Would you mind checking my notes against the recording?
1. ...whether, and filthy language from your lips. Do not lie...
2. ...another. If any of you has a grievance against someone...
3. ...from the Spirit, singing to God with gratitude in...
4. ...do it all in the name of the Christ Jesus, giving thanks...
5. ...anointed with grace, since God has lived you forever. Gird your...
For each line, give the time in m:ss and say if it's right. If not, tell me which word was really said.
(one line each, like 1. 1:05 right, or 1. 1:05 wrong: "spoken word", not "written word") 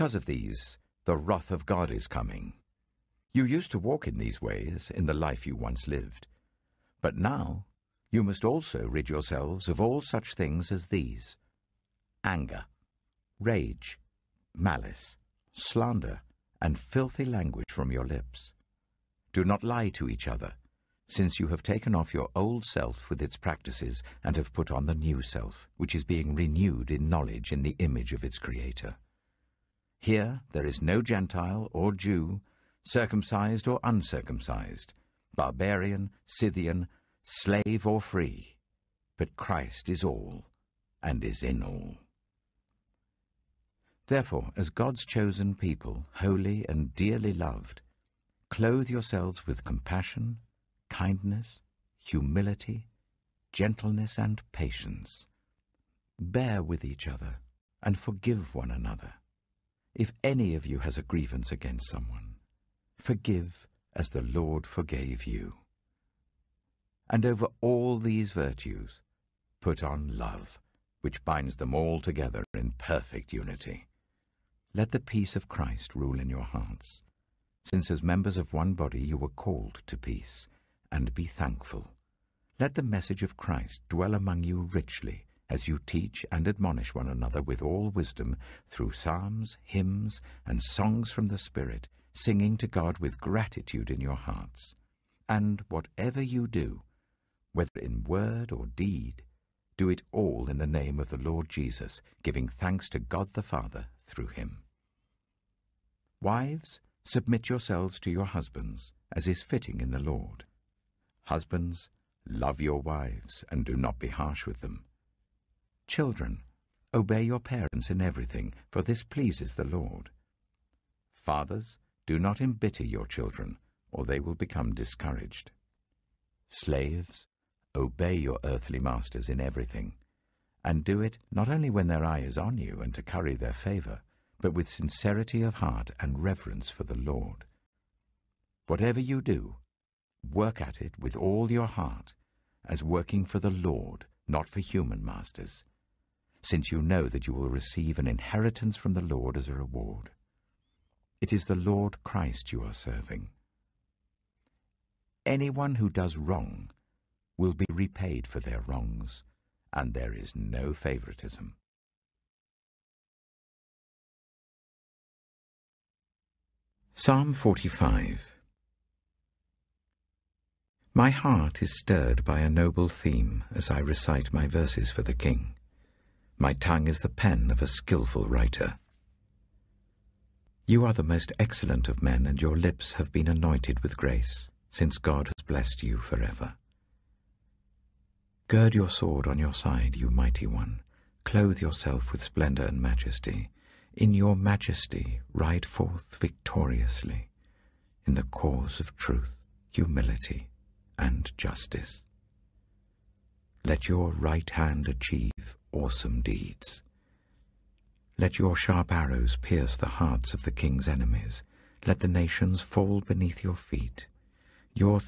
1. 0:15 wrong: "slander", not "whether"
2. 0:58 right
3. 1:31 right
4. 1:39 wrong: "Lord", not "Christ"
5. 3:03 wrong: "blessed", not "lived".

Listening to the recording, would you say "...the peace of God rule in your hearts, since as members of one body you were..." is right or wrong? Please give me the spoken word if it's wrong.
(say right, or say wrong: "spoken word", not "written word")
wrong: "Christ", not "God".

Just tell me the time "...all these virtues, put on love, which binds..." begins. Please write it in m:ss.
1:07.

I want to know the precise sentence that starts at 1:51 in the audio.
Husbands, love your wives and do not be harsh with them.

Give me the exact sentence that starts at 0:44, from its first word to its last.
Therefore, as God's chosen people, holy and dearly loved, clothe yourselves with compassion, kindness, humility, gentleness, and patience.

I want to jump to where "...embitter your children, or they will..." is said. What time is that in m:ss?
2:02.